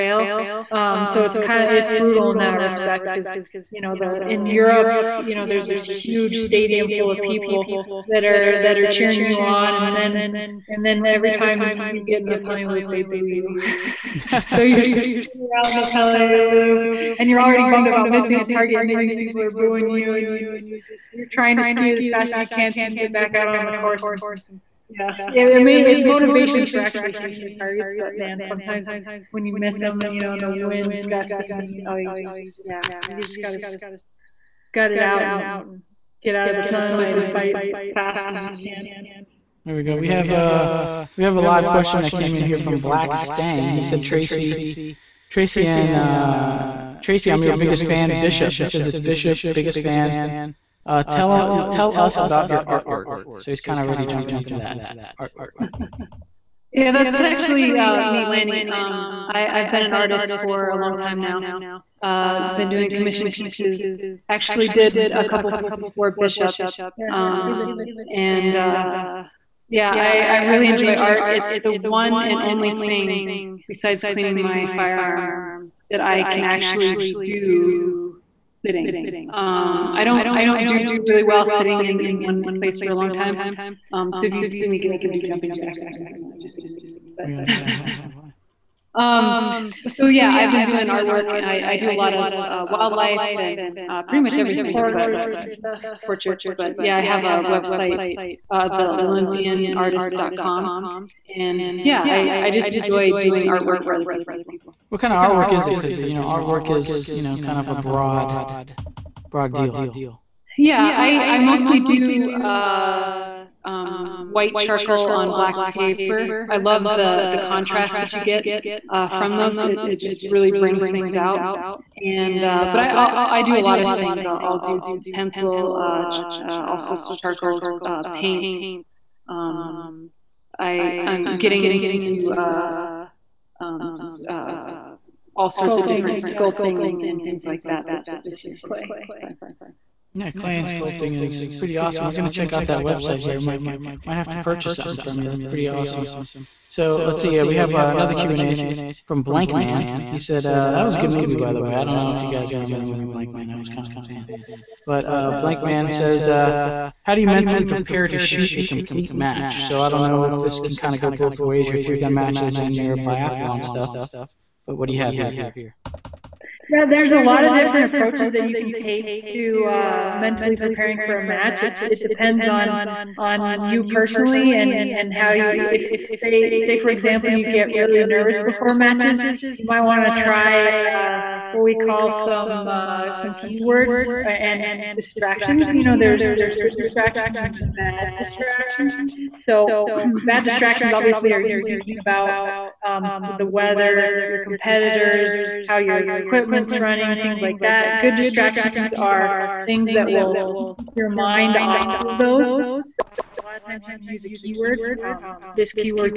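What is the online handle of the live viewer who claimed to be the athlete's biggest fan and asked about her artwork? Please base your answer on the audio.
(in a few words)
Black Stang.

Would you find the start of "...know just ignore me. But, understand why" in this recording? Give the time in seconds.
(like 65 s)
86 s.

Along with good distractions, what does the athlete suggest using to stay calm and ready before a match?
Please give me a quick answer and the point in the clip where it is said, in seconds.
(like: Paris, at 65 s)
Keyword, at 204 s.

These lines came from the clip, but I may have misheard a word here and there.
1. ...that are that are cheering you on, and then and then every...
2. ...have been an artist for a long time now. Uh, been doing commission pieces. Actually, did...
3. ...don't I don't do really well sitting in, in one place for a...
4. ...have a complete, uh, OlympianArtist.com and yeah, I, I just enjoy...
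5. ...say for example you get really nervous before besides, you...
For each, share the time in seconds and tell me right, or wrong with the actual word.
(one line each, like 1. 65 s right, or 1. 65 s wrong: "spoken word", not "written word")
1. 8 s right
2. 59 s right
3. 80 s right
4. 97 s wrong: "website", not "complete"
5. 176 s wrong: "matches", not "besides".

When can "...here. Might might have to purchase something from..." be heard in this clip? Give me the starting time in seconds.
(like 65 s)
143 s.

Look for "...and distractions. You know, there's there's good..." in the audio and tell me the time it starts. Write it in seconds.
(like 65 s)
184 s.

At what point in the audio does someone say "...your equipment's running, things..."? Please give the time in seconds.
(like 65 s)
195 s.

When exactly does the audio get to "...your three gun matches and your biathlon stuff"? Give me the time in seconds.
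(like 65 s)
161 s.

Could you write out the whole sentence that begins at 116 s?
I love the the contrast that you get uh, from those.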